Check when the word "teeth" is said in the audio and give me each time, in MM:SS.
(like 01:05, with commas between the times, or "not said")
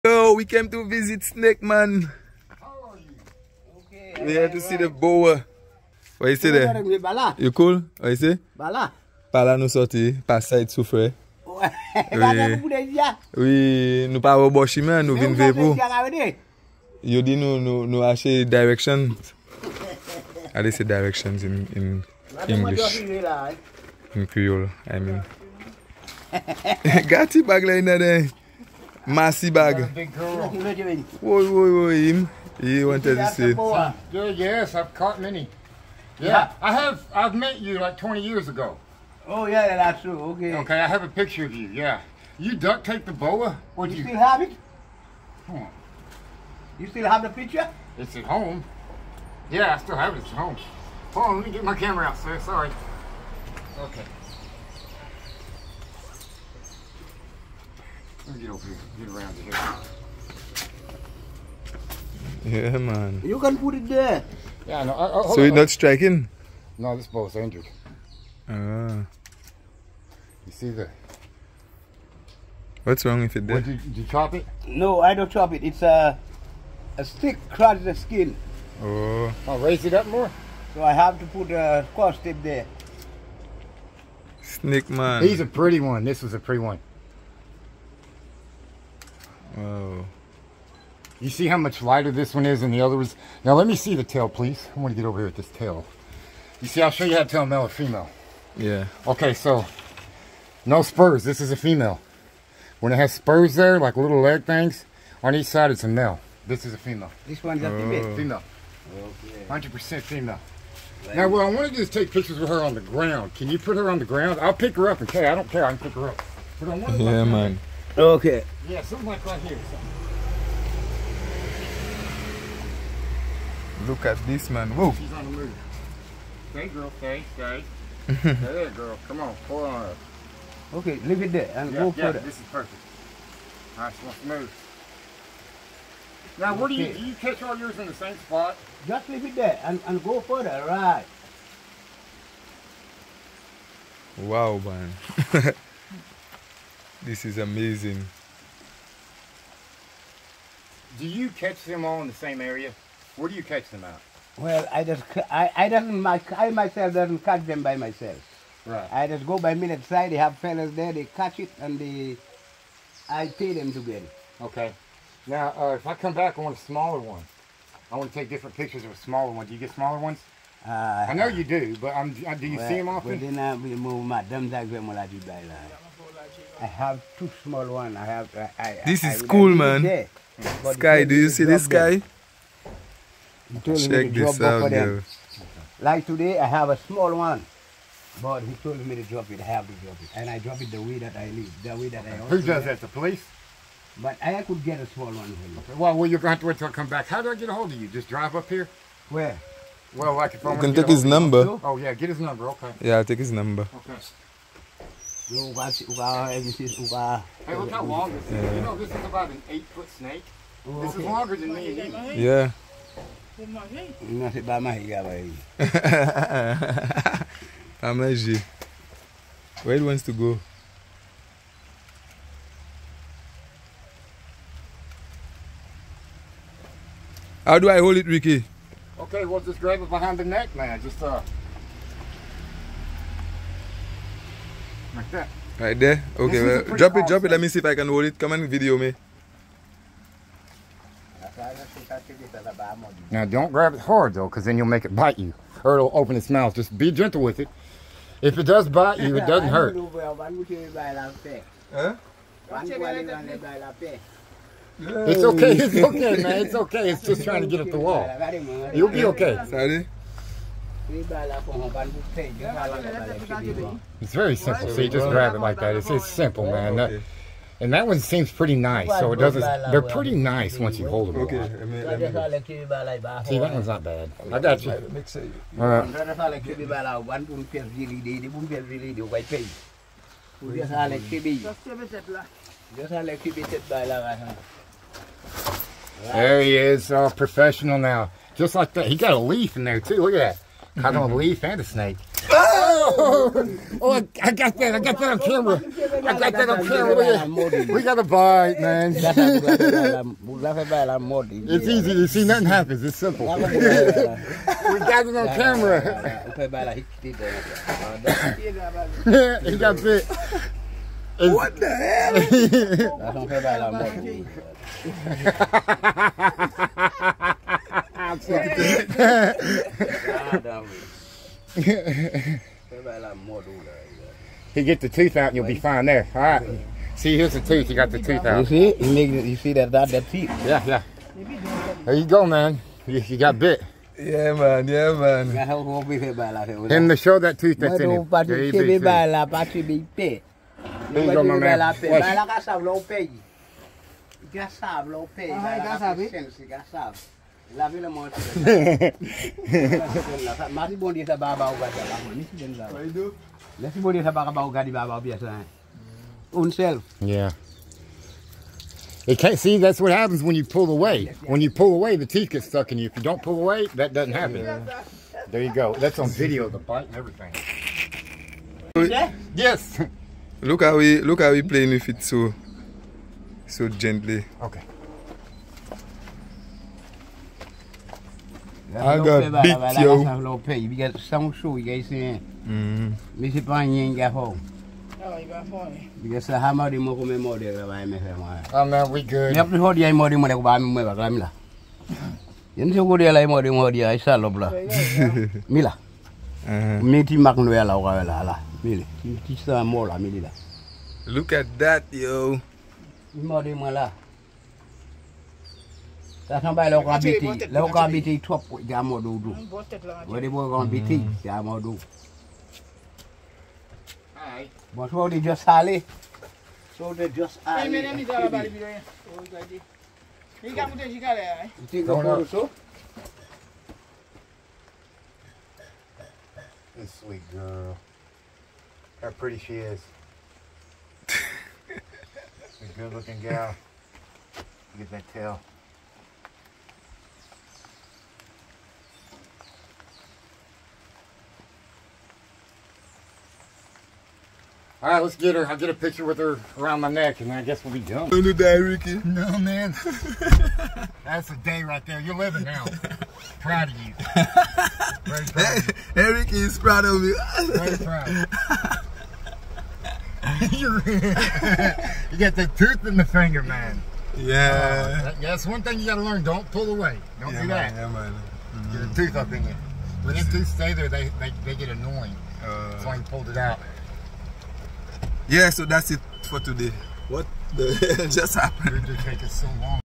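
05:30, 06:02.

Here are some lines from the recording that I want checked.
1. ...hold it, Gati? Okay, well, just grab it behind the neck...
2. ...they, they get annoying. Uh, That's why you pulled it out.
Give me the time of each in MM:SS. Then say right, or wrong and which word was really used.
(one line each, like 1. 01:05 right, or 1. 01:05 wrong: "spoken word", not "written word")
1. 03:47 wrong: "Ricky", not "Gati"
2. 07:51 right.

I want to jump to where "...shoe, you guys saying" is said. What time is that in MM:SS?
06:21.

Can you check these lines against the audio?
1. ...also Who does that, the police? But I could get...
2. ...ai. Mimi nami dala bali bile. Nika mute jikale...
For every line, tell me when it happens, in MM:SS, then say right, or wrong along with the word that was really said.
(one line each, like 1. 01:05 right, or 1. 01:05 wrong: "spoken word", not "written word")
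1. 03:12 right
2. 06:57 right.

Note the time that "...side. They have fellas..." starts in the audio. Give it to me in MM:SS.
02:39.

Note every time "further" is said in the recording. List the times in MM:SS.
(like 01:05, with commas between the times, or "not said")
02:20.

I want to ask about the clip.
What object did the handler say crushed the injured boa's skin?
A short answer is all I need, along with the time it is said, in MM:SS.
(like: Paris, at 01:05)
a stick, at 01:16.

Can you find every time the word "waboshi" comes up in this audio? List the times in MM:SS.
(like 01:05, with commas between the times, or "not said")
00:14.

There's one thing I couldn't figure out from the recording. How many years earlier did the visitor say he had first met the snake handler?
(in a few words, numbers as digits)
20 years.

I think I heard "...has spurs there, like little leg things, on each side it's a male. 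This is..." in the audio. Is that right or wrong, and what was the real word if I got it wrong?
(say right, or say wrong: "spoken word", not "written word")
right.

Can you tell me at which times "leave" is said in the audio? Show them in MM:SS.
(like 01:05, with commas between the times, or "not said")
02:11, 02:19.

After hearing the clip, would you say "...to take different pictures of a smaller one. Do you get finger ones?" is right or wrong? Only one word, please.
wrong.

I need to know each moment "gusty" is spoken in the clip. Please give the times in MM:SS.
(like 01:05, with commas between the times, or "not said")
not said.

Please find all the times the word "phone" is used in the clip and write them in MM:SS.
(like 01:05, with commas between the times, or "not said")
06:25.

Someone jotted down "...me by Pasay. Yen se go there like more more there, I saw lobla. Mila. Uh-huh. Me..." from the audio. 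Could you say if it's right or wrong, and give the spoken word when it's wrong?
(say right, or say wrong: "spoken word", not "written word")
wrong: "Mila", not "Pasay".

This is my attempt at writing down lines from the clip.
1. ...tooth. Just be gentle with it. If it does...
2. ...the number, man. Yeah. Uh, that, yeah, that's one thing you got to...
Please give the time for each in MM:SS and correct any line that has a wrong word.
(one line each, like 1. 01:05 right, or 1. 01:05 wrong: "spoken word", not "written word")
1. 04:06 wrong: "mouth", not "tooth"
2. 07:42 wrong: "finger", not "number".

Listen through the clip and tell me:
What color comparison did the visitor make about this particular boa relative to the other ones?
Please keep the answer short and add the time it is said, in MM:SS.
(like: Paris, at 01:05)
lighter, at 01:31.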